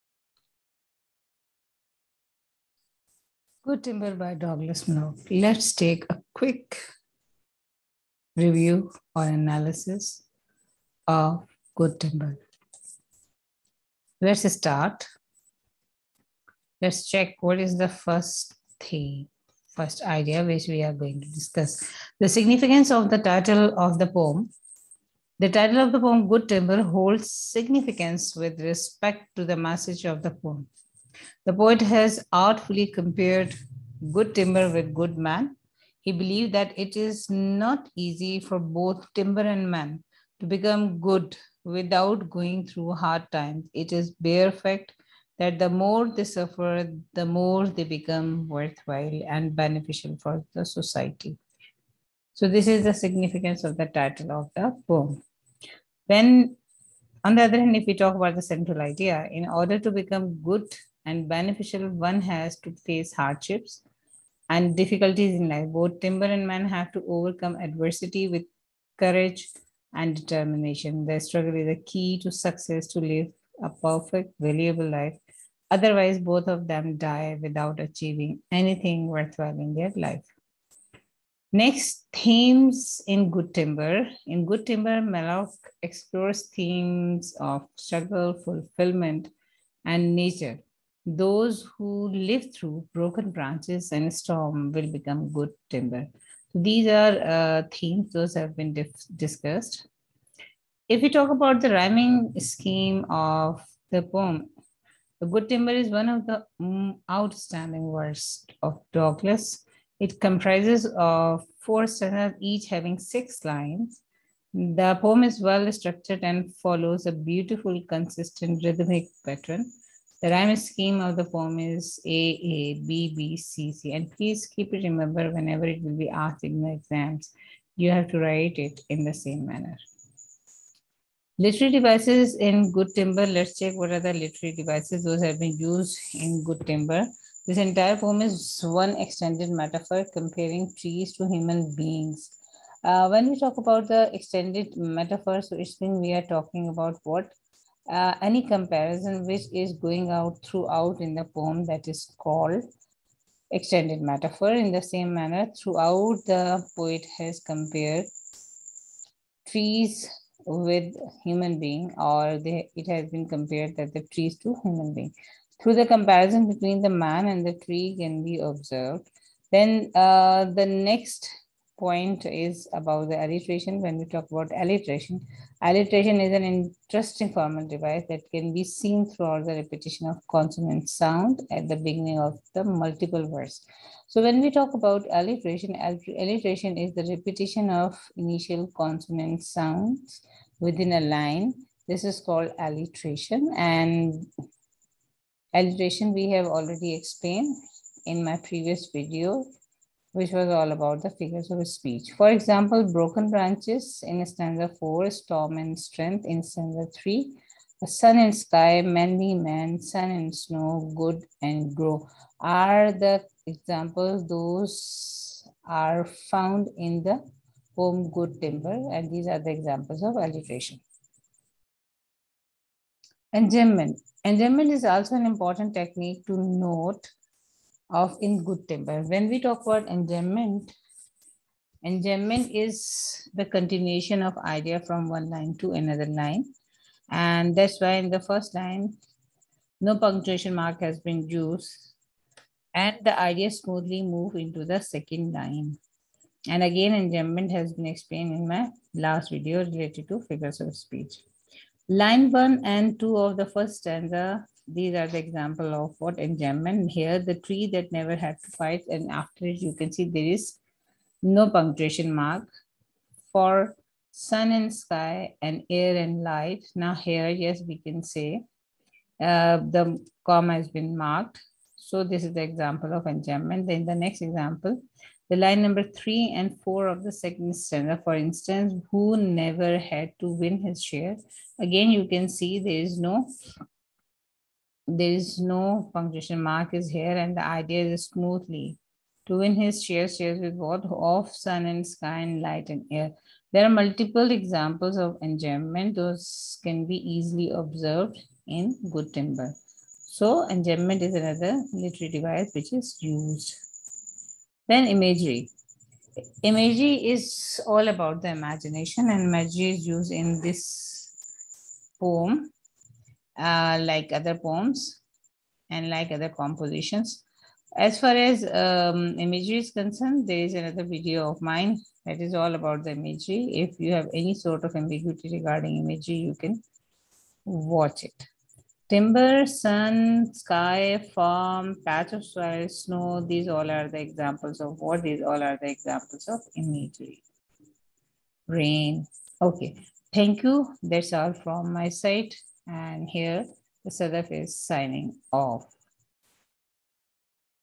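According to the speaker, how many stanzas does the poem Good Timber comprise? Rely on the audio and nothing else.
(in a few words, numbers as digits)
4.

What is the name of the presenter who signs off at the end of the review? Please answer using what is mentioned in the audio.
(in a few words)
Sadaf.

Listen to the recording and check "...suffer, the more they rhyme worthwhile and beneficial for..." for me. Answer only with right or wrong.
wrong.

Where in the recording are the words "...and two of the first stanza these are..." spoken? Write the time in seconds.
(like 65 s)
252 s.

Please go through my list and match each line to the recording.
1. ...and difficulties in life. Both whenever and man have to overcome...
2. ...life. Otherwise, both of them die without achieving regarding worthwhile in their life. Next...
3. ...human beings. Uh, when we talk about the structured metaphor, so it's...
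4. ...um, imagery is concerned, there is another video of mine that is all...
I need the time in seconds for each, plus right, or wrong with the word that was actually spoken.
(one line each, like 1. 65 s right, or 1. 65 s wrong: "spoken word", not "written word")
1. 64 s wrong: "timber", not "whenever"
2. 74 s wrong: "anything", not "regarding"
3. 141 s wrong: "extended", not "structured"
4. 318 s right.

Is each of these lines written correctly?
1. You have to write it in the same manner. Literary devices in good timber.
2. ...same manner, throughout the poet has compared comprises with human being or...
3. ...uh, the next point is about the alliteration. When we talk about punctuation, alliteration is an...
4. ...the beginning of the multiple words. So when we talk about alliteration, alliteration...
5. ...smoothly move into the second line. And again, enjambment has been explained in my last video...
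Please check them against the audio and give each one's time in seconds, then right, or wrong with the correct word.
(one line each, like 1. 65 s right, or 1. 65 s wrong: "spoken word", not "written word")
1. 127 s right
2. 154 s wrong: "trees", not "comprises"
3. 169 s wrong: "alliteration", not "punctuation"
4. 181 s right
5. 243 s right.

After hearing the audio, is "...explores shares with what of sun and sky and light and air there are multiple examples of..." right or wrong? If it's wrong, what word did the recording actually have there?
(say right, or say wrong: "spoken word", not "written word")
wrong: "shares", not "explores".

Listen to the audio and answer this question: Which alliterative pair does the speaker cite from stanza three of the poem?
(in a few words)
storm and strength.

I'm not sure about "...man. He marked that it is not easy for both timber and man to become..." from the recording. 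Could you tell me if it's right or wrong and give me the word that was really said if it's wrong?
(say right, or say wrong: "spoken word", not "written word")
wrong: "believed", not "marked".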